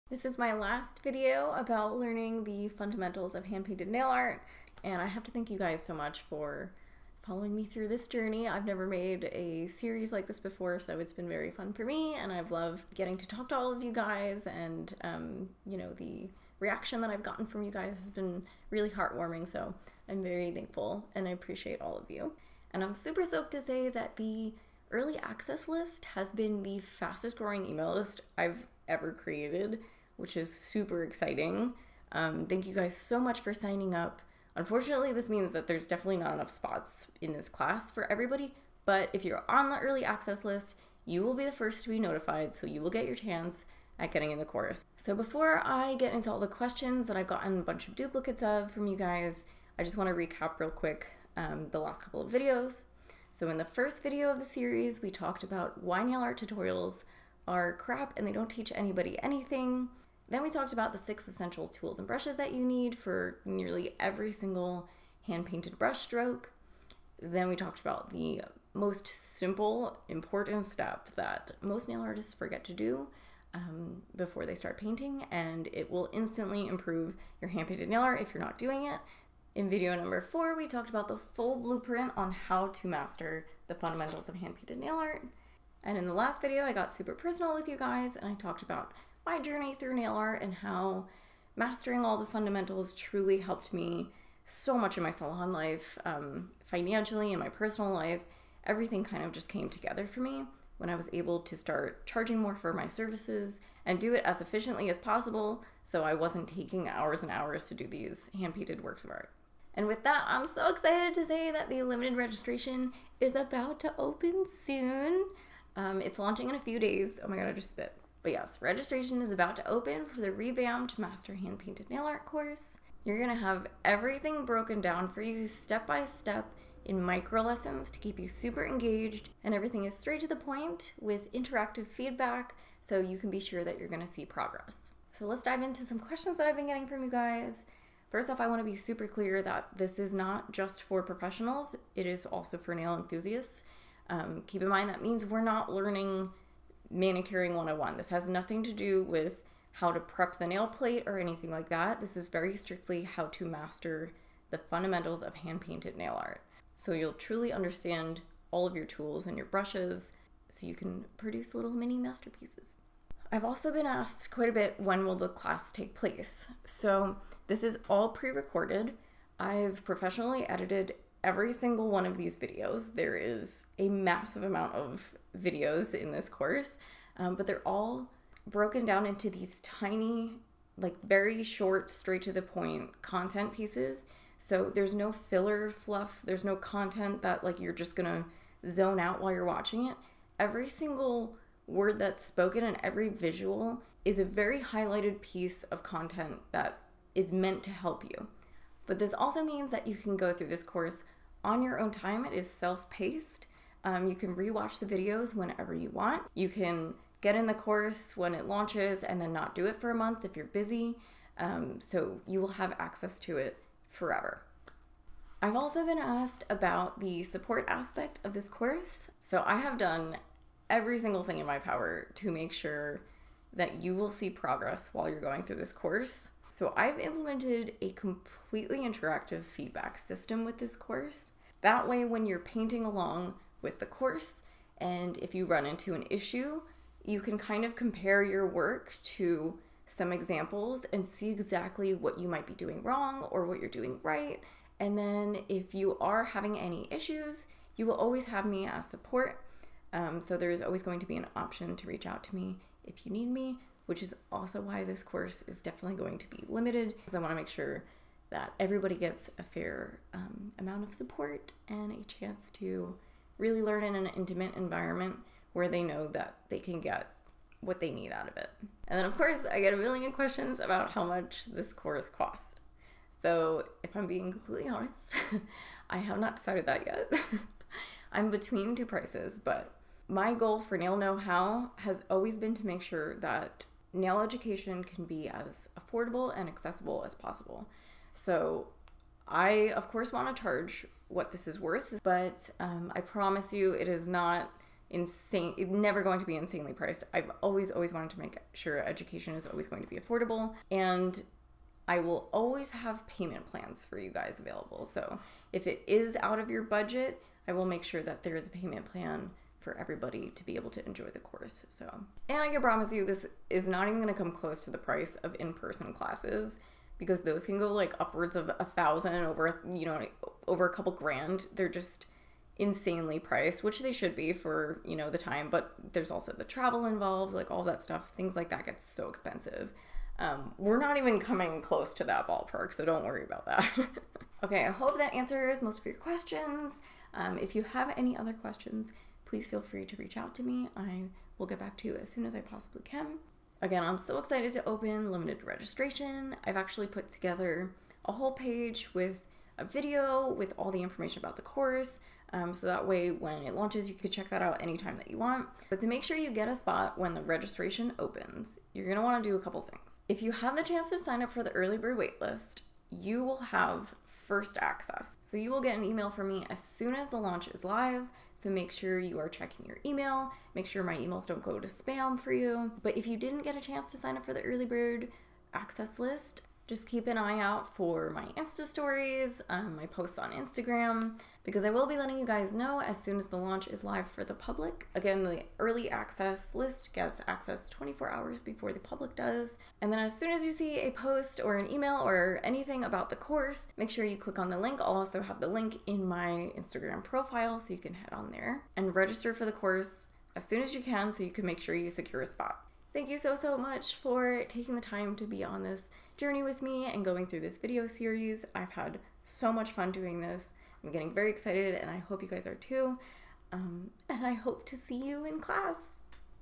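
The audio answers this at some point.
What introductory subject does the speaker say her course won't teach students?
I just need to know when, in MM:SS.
02:26.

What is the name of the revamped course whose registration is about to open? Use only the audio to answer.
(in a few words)
Master Hand Painted Nail Art.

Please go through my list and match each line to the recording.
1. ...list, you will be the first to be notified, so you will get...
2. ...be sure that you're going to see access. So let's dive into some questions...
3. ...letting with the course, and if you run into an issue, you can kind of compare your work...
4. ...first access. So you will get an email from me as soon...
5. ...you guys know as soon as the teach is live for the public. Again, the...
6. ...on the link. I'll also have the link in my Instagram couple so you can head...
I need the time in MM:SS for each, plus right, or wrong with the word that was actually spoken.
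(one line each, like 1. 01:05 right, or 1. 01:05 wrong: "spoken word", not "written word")
1. 00:40 right
2. 02:13 wrong: "progress", not "access"
3. 03:52 wrong: "along", not "letting"
4. 06:04 right
5. 06:22 wrong: "launch", not "teach"
6. 06:34 wrong: "profile", not "couple".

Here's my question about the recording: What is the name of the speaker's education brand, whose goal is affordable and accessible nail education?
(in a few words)
Nail Know How.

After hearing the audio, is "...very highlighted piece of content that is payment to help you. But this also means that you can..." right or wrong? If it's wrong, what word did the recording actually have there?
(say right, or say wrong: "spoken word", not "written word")
wrong: "meant", not "payment".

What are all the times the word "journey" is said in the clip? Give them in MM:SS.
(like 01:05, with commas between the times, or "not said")
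00:08, 01:29, 06:46.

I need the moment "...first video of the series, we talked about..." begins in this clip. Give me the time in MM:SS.
00:53.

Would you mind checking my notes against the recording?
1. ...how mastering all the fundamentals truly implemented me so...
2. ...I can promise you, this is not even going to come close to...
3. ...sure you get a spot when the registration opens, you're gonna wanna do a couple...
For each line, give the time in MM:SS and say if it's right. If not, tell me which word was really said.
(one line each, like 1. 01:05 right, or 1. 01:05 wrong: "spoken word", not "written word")
1. 01:30 wrong: "helped", not "implemented"
2. 05:12 right
3. 05:56 right.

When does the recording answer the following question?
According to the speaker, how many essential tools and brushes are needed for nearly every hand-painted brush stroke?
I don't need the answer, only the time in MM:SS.
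01:00.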